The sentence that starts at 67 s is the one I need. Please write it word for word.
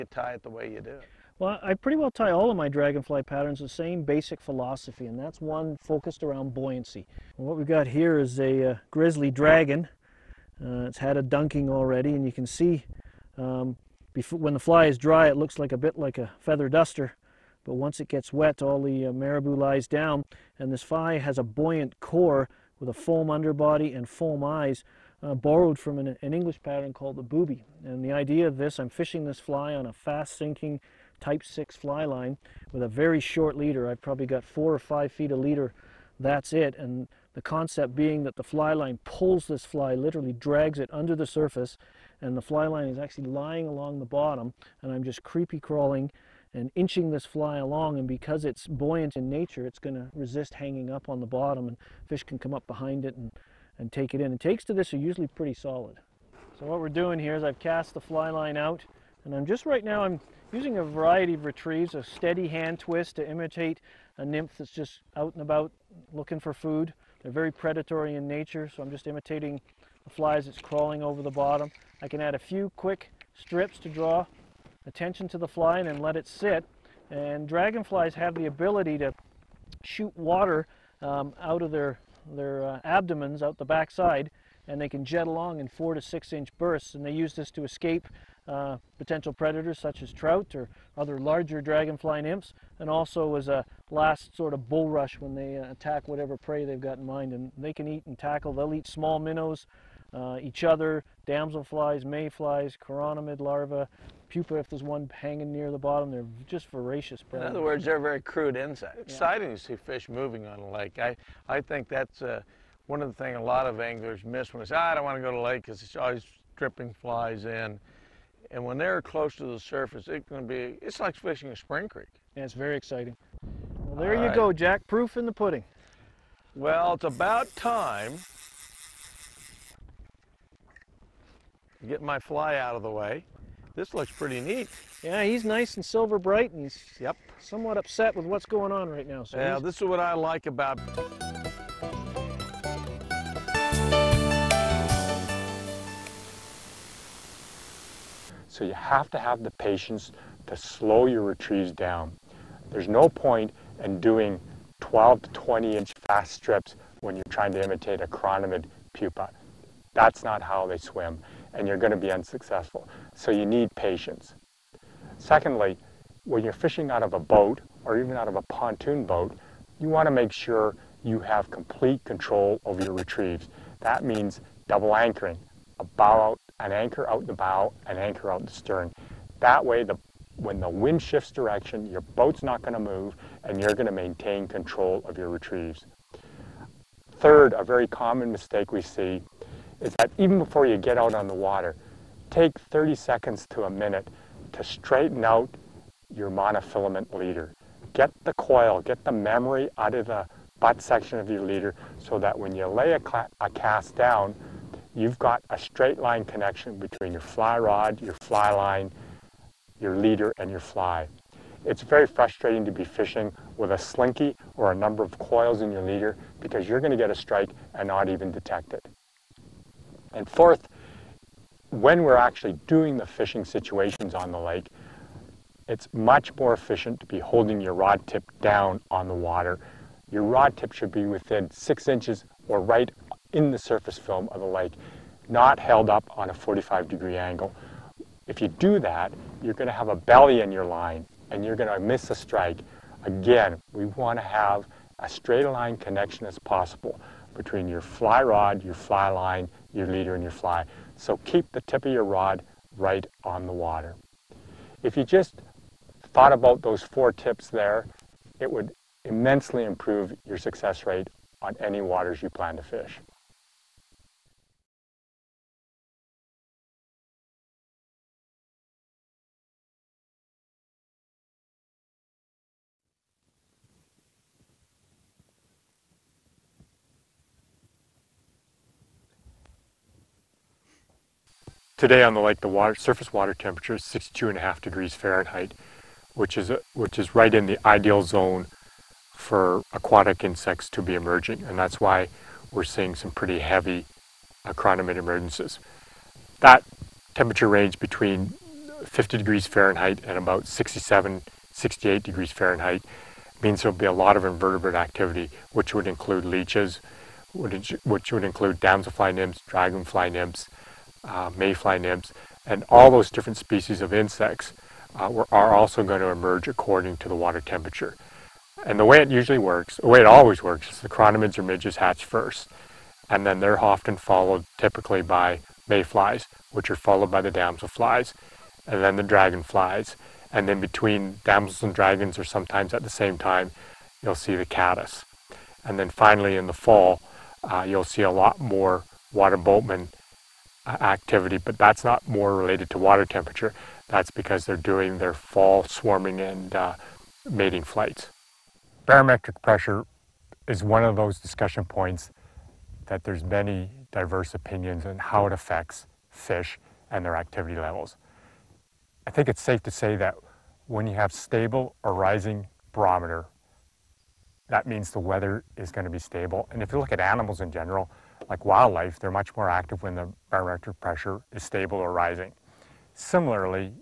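They're very predatory in nature, so I'm just imitating the flies that's crawling over the bottom.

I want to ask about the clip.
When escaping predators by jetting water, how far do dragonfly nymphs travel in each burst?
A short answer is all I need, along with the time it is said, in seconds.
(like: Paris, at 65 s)
4 to 6 inches, at 85 s.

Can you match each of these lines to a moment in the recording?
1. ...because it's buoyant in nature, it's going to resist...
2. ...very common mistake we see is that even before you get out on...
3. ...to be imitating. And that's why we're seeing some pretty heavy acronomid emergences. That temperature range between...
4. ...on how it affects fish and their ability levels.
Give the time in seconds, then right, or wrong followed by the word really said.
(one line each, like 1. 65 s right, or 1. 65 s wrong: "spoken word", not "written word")
1. 48 s right
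2. 187 s right
3. 290 s wrong: "emerging", not "imitating"
4. 354 s wrong: "activity", not "ability".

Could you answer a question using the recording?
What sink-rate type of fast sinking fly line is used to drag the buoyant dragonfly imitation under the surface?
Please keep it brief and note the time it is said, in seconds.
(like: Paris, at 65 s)
type 6, at 31 s.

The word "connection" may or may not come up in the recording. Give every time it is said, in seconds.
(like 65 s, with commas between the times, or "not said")
206 s, 245 s.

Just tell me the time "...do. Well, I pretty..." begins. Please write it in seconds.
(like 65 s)
0 s.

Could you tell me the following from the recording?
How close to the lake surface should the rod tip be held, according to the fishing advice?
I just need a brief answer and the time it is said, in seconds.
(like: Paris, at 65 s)
6 inches, at 231 s.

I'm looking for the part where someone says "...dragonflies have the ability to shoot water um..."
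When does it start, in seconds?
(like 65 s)
77 s.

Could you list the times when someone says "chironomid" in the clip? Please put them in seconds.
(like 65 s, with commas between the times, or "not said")
102 s, 158 s, 320 s.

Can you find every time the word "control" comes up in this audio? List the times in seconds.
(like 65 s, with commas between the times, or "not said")
172 s, 184 s.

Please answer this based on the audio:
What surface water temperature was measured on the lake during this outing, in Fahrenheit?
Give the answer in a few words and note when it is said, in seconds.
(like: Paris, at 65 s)
62.5 degrees, at 283 s.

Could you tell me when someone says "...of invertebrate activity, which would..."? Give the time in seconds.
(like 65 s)
304 s.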